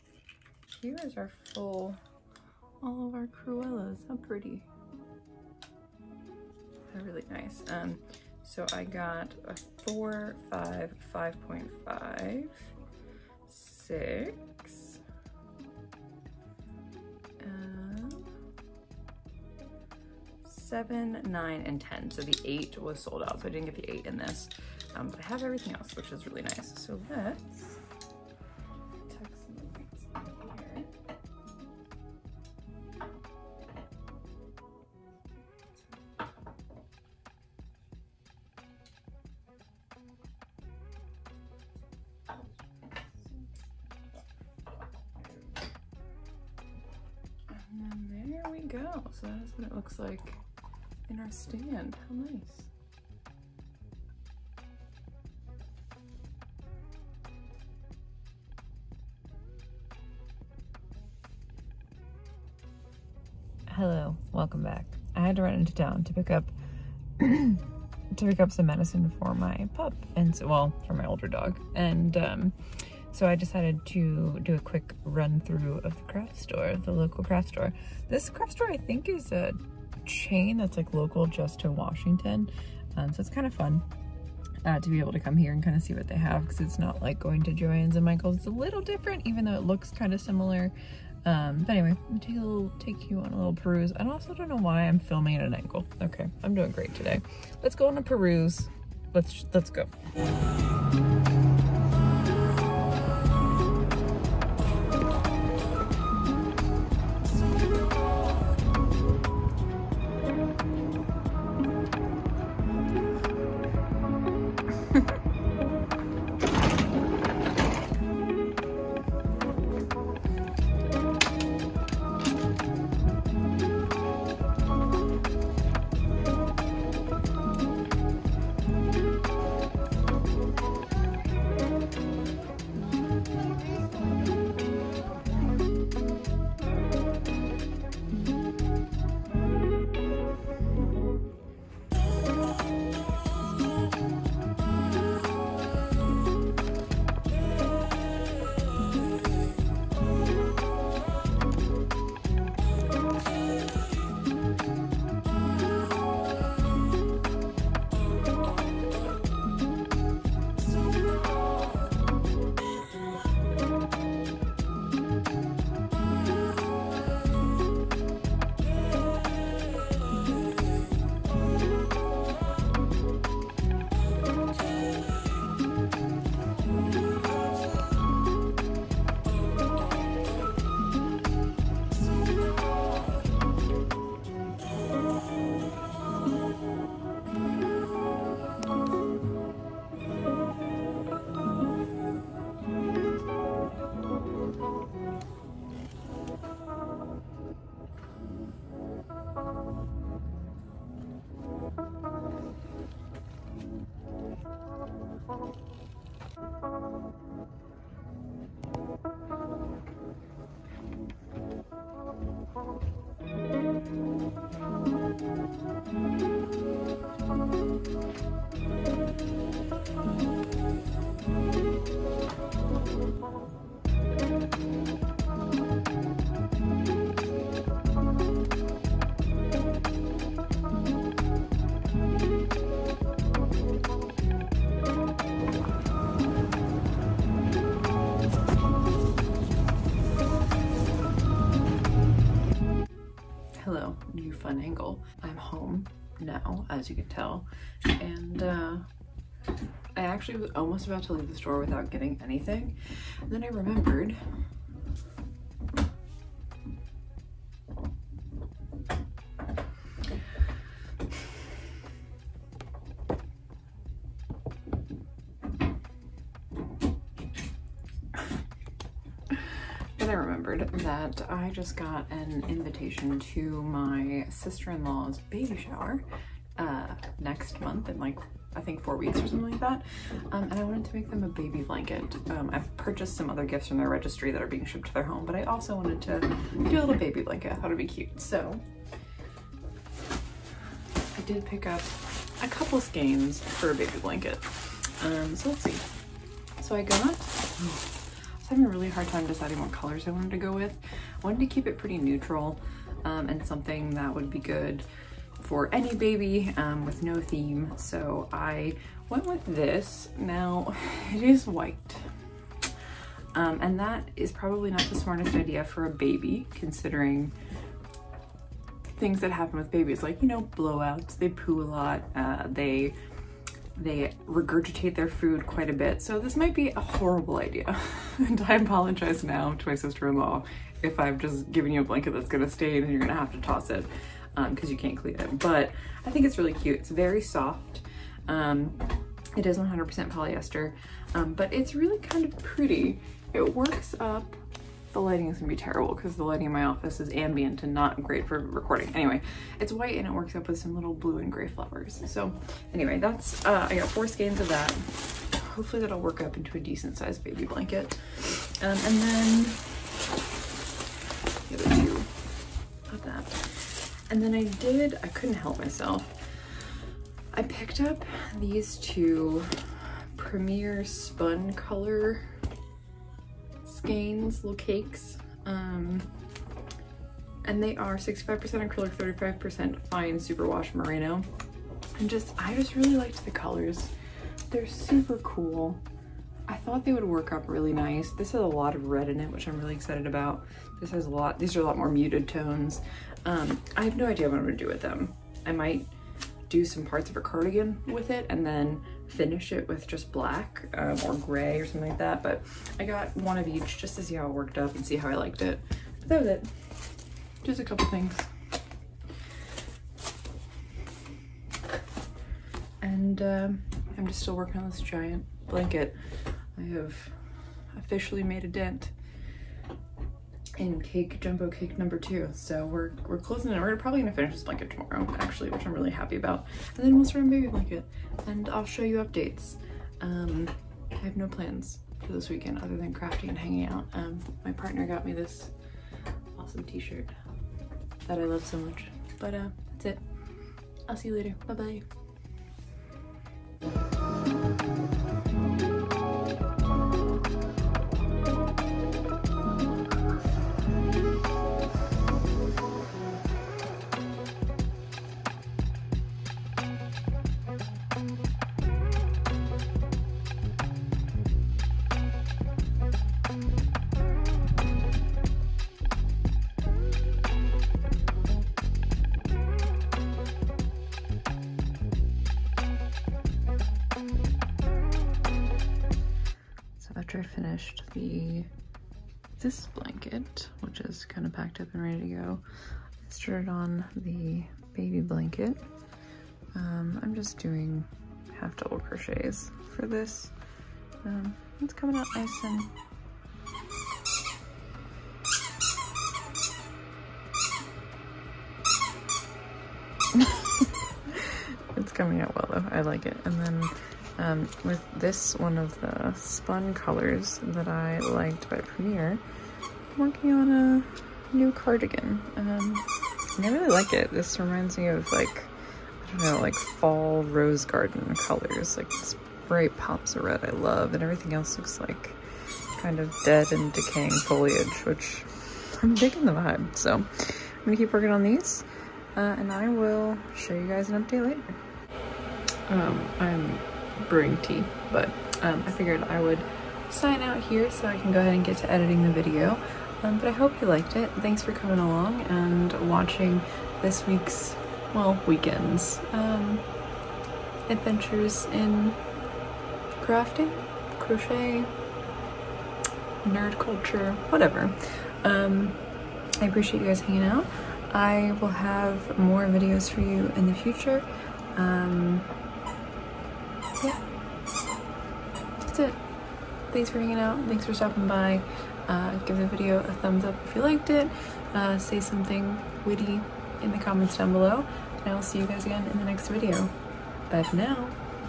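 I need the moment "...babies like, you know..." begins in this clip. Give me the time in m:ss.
5:19.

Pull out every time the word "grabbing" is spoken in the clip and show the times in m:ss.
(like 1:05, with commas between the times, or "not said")
not said.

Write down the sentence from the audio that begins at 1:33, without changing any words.
I also don't know why I'm filming at an angle.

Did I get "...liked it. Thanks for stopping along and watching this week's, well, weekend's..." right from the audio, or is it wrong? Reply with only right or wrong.
wrong.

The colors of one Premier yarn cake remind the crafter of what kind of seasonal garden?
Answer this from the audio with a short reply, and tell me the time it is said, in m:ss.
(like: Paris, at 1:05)
Fall rose garden, at 8:36.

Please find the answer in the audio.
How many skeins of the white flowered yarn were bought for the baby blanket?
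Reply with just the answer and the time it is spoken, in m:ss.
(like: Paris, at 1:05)
4, at 5:53.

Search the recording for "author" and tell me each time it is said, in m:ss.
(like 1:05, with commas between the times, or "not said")
not said.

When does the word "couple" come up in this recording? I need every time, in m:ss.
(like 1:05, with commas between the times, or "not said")
4:52, 6:47.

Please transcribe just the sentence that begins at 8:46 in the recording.
So I'm gonna keep working on these uh, and I will show you guys an update later.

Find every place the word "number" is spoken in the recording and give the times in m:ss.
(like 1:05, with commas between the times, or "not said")
7:01.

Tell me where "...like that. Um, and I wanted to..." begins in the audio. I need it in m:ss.
4:39.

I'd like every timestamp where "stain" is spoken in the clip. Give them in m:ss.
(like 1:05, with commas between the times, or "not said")
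5:32.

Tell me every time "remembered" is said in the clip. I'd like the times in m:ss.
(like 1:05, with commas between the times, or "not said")
4:13, 4:30.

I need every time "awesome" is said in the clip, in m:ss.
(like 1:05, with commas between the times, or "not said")
7:16.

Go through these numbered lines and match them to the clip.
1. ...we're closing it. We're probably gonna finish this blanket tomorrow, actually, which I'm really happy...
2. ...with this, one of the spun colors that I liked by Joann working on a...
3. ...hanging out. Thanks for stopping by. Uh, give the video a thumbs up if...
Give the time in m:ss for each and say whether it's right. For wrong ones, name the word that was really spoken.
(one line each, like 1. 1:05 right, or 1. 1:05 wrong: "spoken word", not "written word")
1. 7:03 right
2. 8:24 wrong: "Premier", not "Joann"
3. 9:26 right.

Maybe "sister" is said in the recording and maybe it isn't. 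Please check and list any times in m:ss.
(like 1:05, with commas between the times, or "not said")
4:34, 5:29.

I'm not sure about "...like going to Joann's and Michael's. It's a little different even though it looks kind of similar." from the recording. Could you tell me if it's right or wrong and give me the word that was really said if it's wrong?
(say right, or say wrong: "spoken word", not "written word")
right.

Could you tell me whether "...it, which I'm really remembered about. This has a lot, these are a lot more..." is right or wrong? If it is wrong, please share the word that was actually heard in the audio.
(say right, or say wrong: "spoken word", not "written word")
wrong: "excited", not "remembered".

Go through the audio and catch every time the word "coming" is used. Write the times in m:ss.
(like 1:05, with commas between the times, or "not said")
8:11, 8:21, 9:01.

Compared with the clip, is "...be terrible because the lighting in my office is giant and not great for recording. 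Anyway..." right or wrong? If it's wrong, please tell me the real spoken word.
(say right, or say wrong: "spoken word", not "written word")
wrong: "ambient", not "giant".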